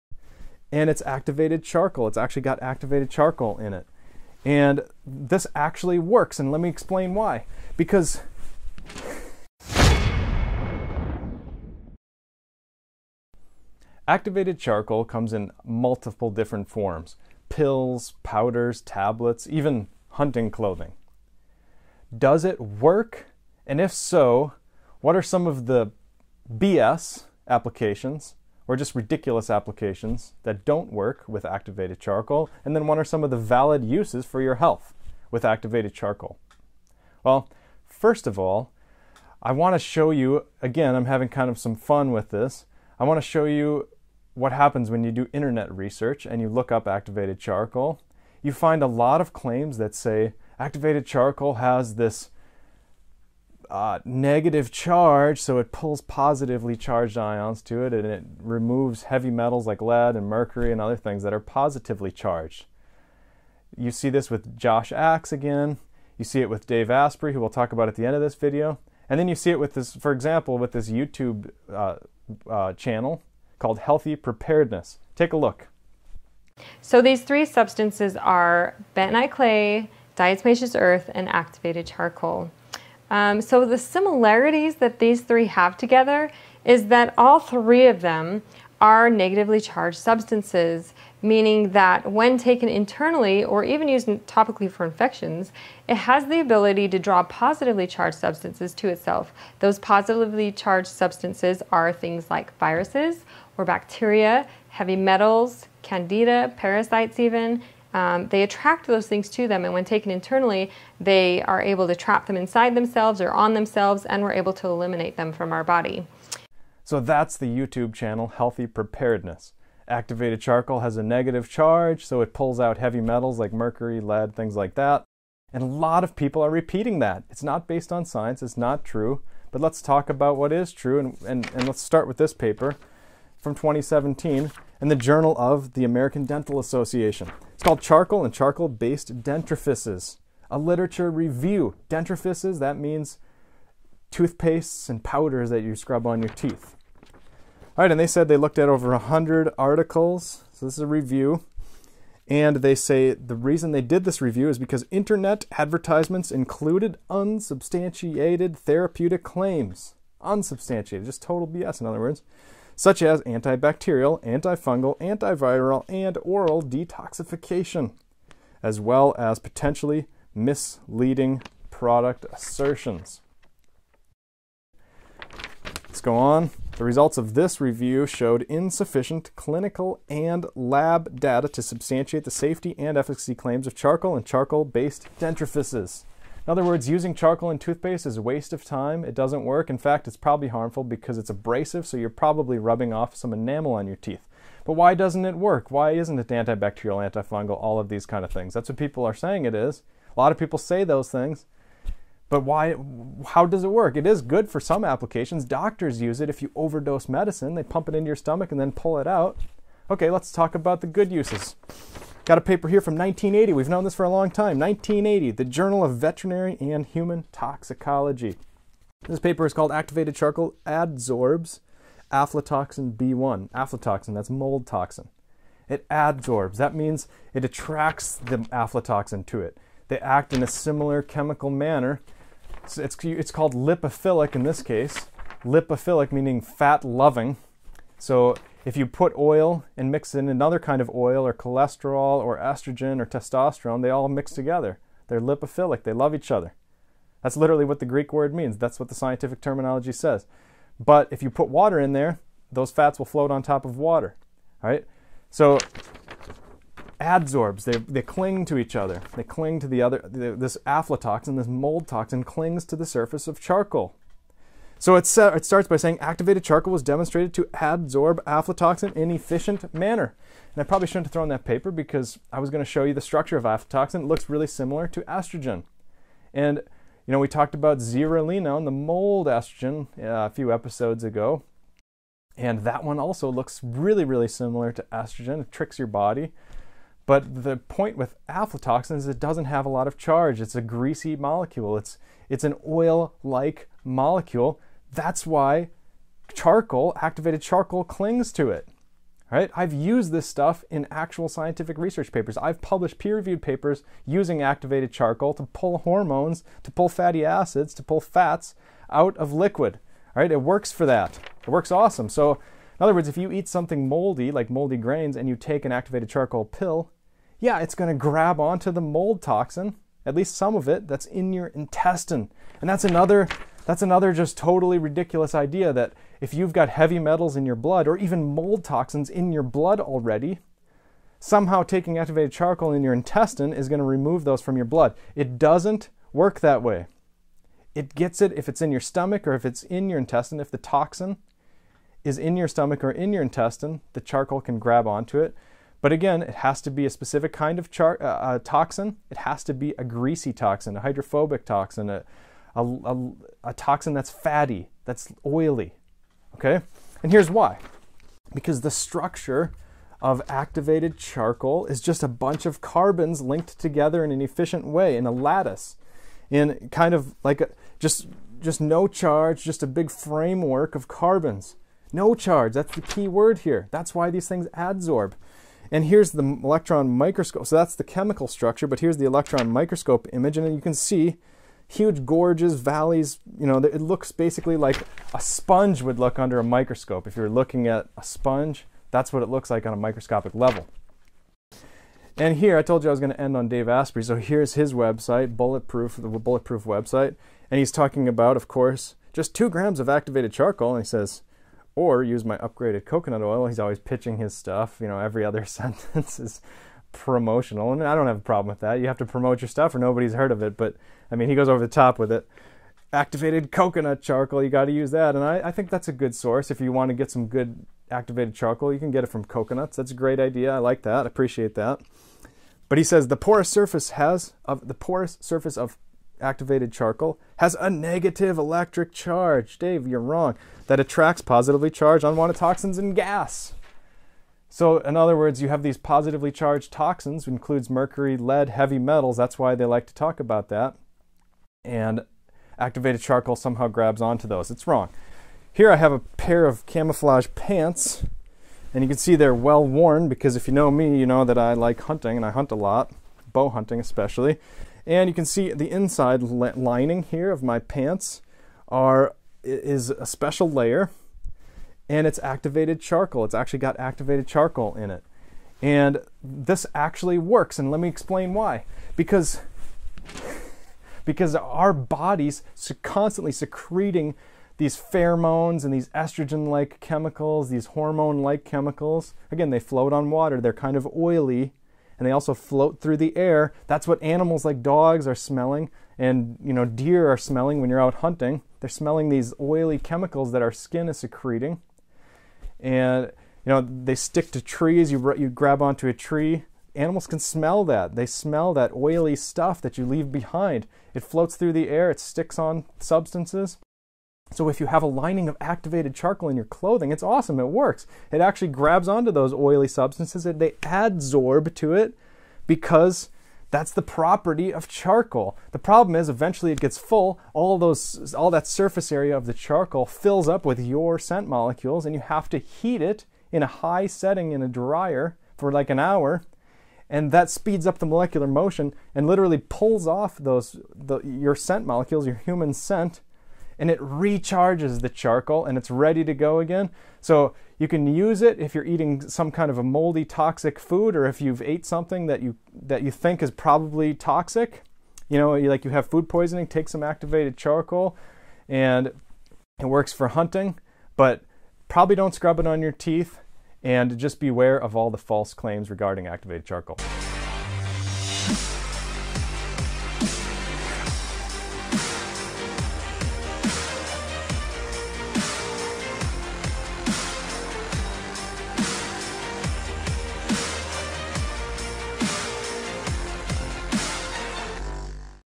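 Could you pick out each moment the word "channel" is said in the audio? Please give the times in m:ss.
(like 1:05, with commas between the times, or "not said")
1:12, 1:57.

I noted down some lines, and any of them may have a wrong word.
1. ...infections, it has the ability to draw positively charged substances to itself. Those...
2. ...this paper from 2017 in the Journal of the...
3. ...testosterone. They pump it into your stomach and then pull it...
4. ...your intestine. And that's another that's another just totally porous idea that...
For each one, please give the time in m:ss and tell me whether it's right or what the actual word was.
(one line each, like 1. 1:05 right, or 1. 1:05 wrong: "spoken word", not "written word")
1. 1:34 right
2. 2:12 right
3. 3:27 wrong: "medicine", not "testosterone"
4. 5:21 wrong: "ridiculous", not "porous".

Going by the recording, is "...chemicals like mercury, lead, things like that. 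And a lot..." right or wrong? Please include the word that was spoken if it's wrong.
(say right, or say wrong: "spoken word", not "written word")
wrong: "metals", not "chemicals".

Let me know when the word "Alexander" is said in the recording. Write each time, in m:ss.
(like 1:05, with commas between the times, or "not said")
not said.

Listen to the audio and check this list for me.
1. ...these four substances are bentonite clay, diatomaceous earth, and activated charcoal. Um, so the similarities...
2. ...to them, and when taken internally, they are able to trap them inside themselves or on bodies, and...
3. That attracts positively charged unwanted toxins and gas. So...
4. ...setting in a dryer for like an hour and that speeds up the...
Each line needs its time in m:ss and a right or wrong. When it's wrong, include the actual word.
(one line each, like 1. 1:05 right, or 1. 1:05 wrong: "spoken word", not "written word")
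1. 1:17 wrong: "three", not "four"
2. 1:49 wrong: "themselves", not "bodies"
3. 7:10 right
4. 8:43 right.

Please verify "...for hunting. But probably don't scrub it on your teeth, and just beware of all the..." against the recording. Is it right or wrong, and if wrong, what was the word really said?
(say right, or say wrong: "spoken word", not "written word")
right.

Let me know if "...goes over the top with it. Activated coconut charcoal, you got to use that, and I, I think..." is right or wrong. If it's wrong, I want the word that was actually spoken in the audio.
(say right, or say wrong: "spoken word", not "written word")
right.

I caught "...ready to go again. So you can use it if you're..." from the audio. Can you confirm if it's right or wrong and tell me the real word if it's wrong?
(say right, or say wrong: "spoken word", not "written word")
right.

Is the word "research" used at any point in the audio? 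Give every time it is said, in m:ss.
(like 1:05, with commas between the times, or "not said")
0:45, 5:01.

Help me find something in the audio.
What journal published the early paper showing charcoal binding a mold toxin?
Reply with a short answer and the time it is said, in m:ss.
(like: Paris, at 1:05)
Journal of Veterinary and Human Toxicology, at 3:35.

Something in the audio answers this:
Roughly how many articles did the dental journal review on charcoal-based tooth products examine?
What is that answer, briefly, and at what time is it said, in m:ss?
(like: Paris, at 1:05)
over 100, at 2:28.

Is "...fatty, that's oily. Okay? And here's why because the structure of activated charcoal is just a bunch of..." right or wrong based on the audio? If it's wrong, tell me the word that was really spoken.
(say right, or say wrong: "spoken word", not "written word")
right.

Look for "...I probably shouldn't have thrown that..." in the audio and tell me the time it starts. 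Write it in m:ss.
4:30.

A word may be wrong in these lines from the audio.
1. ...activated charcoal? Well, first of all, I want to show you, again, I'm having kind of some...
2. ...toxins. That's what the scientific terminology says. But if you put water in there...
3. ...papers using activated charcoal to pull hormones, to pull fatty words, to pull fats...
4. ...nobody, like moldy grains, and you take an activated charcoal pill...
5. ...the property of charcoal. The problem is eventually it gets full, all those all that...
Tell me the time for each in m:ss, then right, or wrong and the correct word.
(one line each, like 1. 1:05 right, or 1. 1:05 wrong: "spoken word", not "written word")
1. 0:35 right
2. 4:08 wrong: "means", not "toxins"
3. 5:03 wrong: "acids", not "words"
4. 5:13 wrong: "moldy", not "nobody"
5. 8:33 right.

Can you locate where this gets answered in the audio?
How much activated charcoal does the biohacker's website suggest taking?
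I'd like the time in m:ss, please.
6:39.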